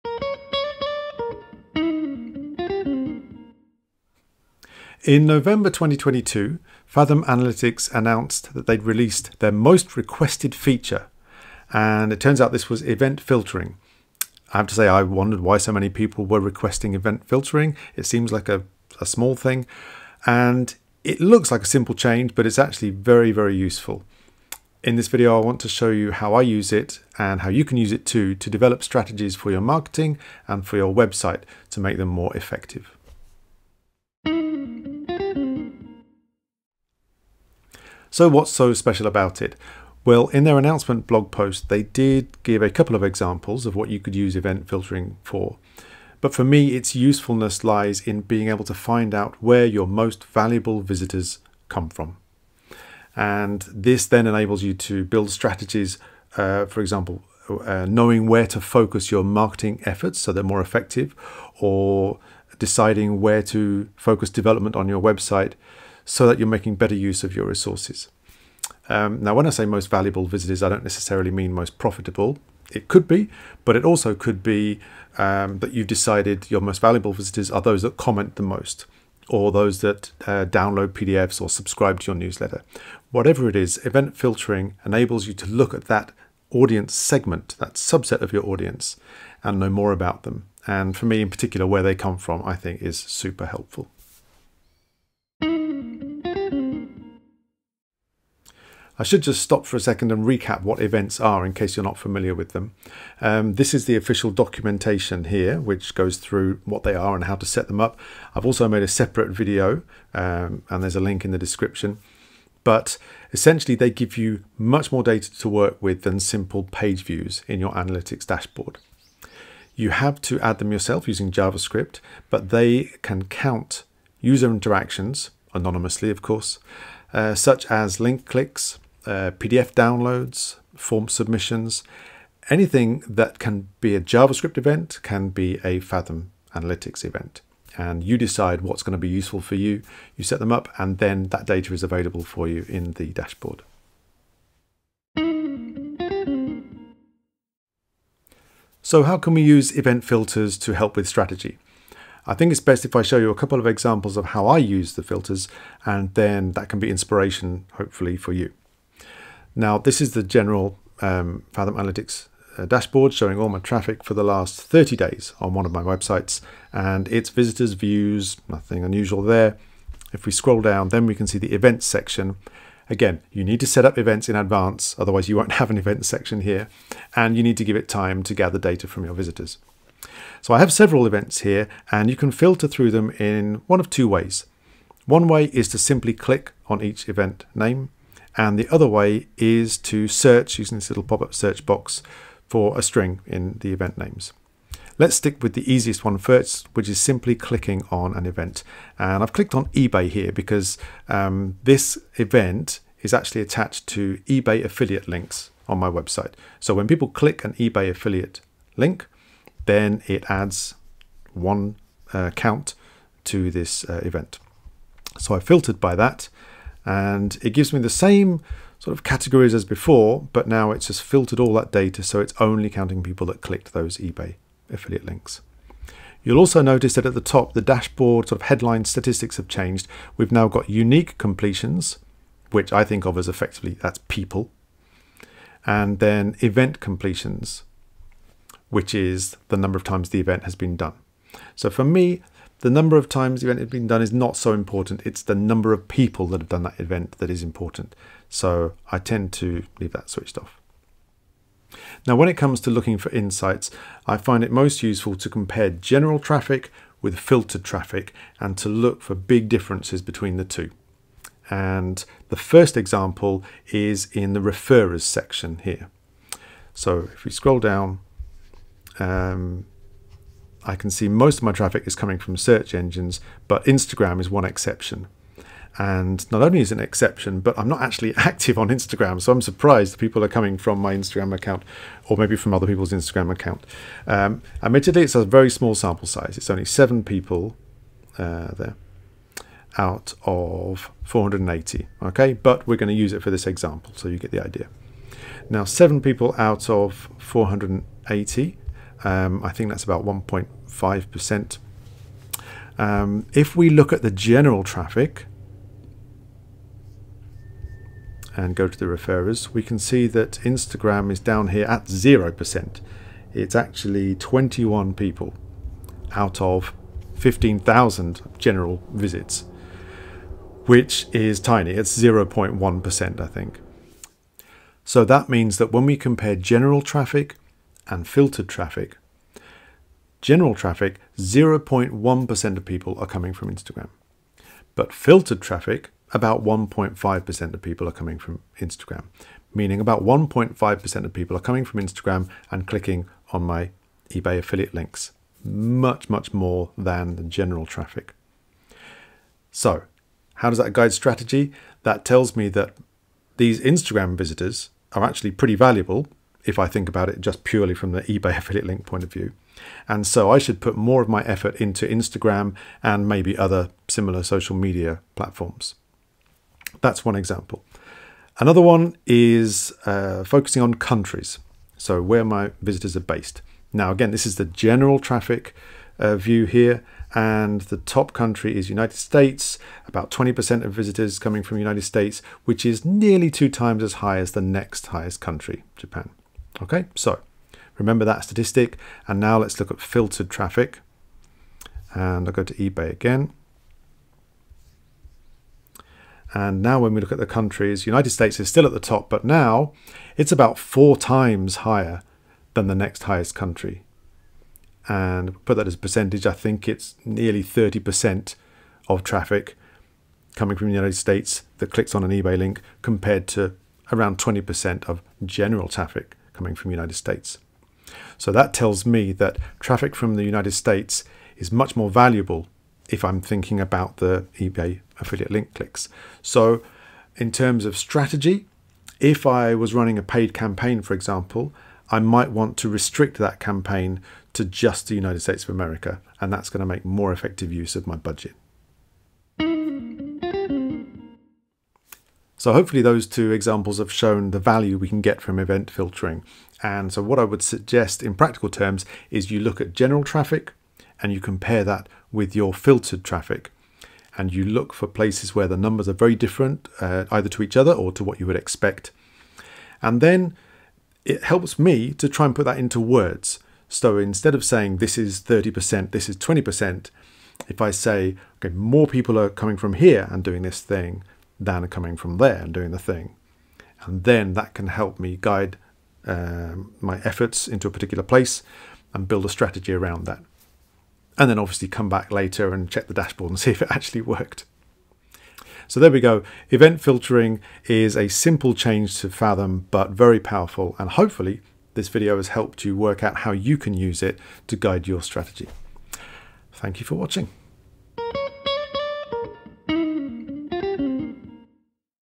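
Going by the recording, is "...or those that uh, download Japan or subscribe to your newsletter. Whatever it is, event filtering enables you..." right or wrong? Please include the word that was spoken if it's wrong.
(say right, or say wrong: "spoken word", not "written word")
wrong: "PDFs", not "Japan".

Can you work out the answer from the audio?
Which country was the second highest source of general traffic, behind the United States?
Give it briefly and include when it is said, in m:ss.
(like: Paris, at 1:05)
Japan, at 6:25.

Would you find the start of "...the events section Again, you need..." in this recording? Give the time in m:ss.
2:51.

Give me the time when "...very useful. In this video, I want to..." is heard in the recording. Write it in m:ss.
0:23.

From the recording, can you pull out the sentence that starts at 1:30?
And for me in particular, where they come from, I think is super helpful.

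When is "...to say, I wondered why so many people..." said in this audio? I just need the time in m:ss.
0:14.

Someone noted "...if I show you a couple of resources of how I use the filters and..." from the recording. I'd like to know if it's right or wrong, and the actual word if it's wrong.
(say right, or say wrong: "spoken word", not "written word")
wrong: "examples", not "resources".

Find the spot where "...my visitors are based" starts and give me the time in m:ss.
6:12.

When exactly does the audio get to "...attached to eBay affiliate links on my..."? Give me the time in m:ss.
3:23.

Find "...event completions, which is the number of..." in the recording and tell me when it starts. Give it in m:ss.
3:56.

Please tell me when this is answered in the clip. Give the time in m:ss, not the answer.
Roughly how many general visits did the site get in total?
5:17.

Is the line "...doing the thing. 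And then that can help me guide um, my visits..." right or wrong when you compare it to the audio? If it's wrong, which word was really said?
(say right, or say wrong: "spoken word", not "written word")
wrong: "efforts", not "visits".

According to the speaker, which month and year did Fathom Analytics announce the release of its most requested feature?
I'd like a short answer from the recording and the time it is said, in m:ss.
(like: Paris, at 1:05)
November 2022, at 0:05.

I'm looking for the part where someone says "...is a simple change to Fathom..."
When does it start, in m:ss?
8:07.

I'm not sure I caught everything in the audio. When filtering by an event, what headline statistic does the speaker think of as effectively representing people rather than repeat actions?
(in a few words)
Unique completions.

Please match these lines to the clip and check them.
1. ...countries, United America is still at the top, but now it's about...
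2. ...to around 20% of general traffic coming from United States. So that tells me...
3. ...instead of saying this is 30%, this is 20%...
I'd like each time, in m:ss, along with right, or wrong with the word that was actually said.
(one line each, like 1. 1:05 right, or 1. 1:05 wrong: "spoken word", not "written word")
1. 6:37 wrong: "States", not "America"
2. 6:53 right
3. 7:43 right.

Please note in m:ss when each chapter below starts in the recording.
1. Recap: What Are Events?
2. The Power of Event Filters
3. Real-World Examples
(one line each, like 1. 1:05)
1. 1:35
2. 0:34
3. 2:25.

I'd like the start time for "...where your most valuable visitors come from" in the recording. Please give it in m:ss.
0:49.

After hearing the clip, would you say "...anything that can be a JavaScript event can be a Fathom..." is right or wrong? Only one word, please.
right.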